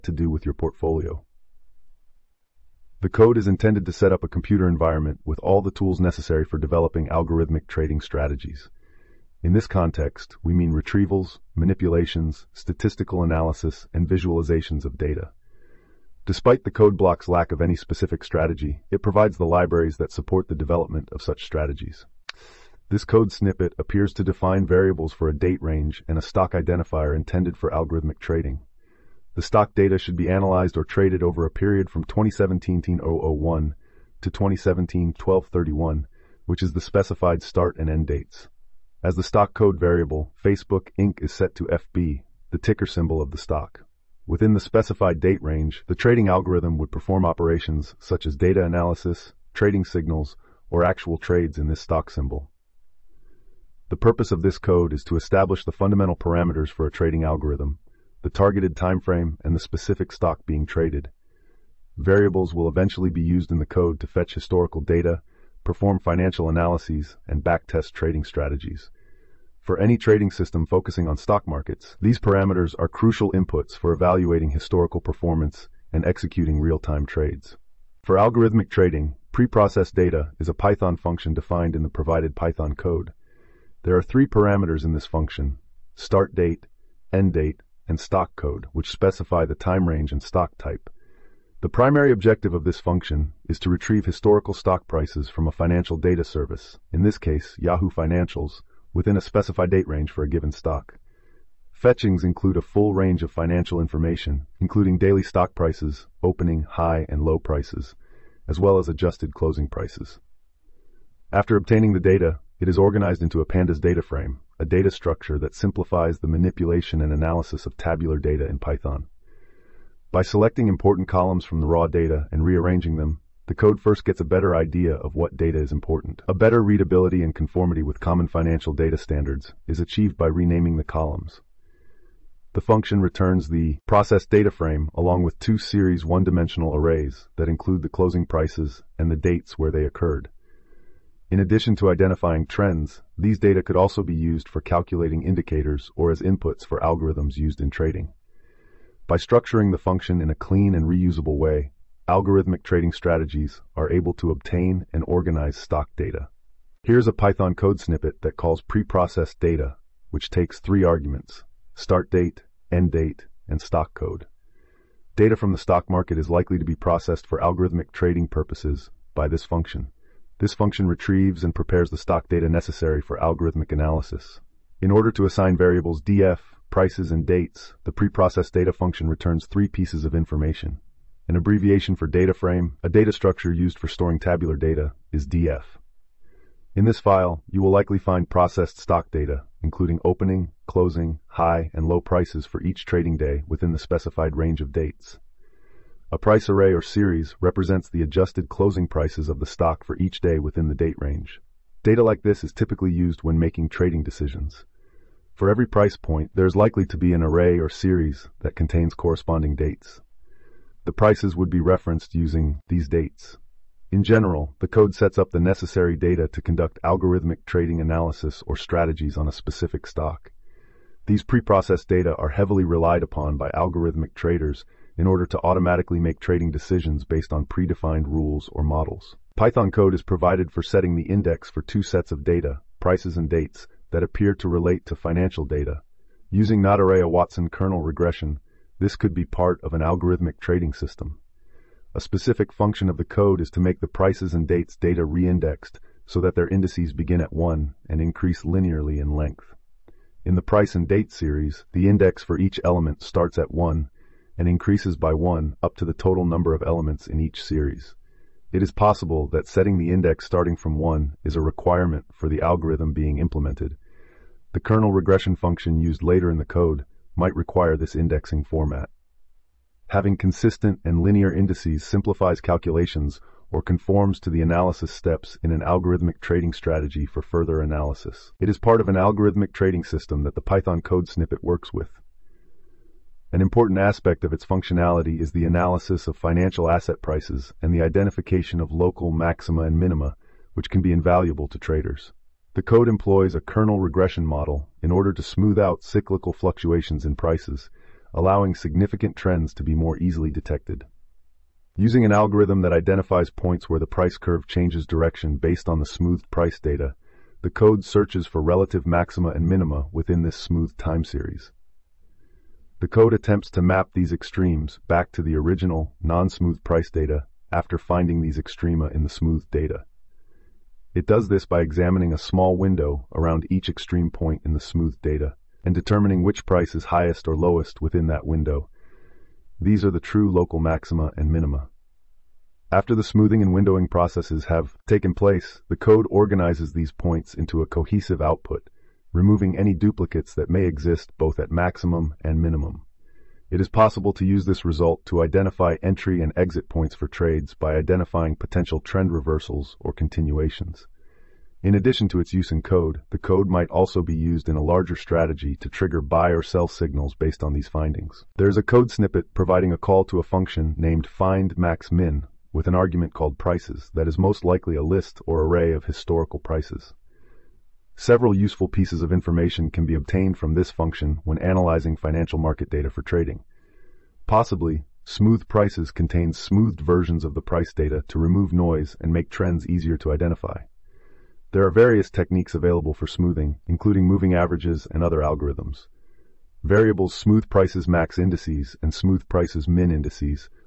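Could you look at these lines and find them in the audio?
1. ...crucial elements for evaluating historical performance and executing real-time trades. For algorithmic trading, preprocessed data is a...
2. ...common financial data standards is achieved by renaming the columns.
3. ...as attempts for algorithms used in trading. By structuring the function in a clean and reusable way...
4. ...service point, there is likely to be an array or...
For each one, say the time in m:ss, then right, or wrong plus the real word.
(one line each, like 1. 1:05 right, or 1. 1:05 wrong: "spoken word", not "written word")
1. 1:12 wrong: "inputs", not "elements"
2. 2:07 right
3. 2:26 wrong: "inputs", not "attempts"
4. 3:25 wrong: "price", not "service".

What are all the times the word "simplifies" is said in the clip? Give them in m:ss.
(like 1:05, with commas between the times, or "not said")
1:55, 4:31.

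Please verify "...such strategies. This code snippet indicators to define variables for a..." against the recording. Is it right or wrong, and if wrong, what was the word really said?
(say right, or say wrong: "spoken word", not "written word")
wrong: "appears", not "indicators".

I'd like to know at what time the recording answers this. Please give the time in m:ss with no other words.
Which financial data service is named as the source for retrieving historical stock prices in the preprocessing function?
1:37.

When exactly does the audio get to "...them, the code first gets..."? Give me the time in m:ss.
2:02.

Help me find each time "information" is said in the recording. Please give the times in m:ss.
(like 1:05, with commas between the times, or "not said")
1:43, 3:00, 6:09.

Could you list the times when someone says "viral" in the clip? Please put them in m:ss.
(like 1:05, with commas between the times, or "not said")
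not said.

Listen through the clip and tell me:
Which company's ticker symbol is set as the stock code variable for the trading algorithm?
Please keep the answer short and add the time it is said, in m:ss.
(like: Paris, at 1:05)
Facebook Inc., at 0:40.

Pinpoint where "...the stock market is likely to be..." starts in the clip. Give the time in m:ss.
2:45.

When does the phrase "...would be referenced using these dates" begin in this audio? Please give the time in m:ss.
3:31.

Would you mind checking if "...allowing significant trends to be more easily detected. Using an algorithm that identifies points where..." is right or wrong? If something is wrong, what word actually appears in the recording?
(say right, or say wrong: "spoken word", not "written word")
right.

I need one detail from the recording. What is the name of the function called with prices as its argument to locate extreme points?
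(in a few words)
findMaxMin.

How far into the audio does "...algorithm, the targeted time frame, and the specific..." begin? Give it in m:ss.
0:57.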